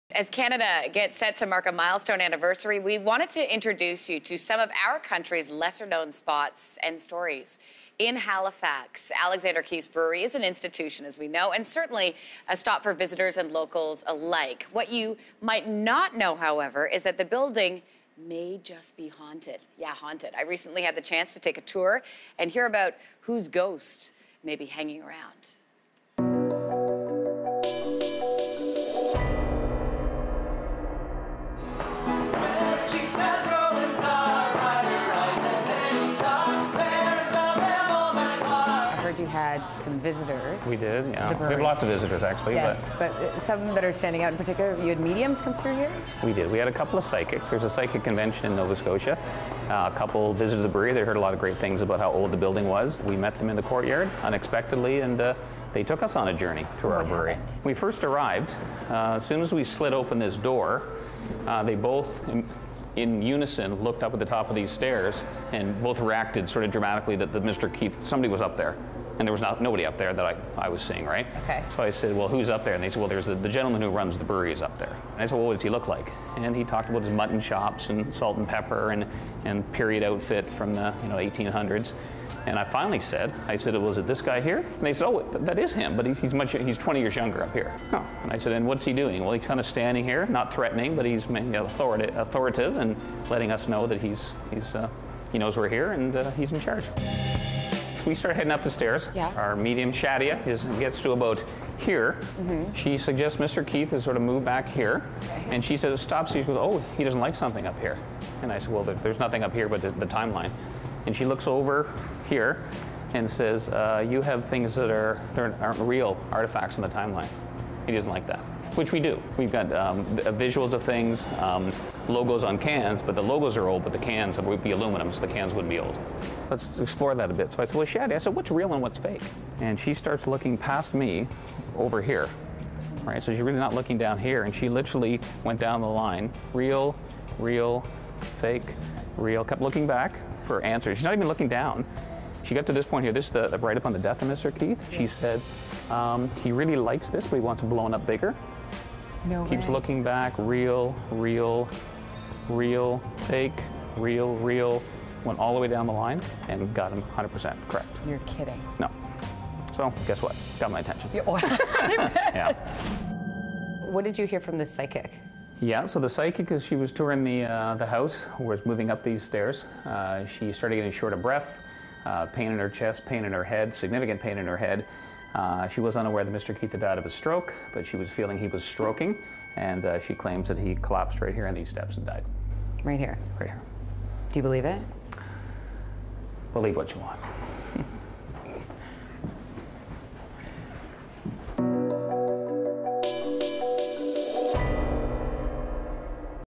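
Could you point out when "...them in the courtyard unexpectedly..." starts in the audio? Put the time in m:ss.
0:53.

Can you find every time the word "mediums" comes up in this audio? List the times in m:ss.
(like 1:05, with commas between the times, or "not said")
0:44, 1:39.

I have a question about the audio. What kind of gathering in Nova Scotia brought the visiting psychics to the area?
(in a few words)
A psychic convention.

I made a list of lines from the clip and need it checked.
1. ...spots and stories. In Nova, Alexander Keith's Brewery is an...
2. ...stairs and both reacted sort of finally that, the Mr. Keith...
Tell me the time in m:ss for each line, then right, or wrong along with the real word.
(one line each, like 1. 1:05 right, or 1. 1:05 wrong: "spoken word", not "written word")
1. 0:06 wrong: "Halifax", not "Nova"
2. 1:04 wrong: "dramatically", not "finally".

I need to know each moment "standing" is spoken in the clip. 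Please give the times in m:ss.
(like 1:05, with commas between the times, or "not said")
0:43, 1:29.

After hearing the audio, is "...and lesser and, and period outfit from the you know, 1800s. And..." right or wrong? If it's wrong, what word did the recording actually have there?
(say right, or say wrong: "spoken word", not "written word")
wrong: "pepper", not "lesser".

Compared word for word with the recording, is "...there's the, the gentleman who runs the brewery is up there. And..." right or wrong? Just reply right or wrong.
right.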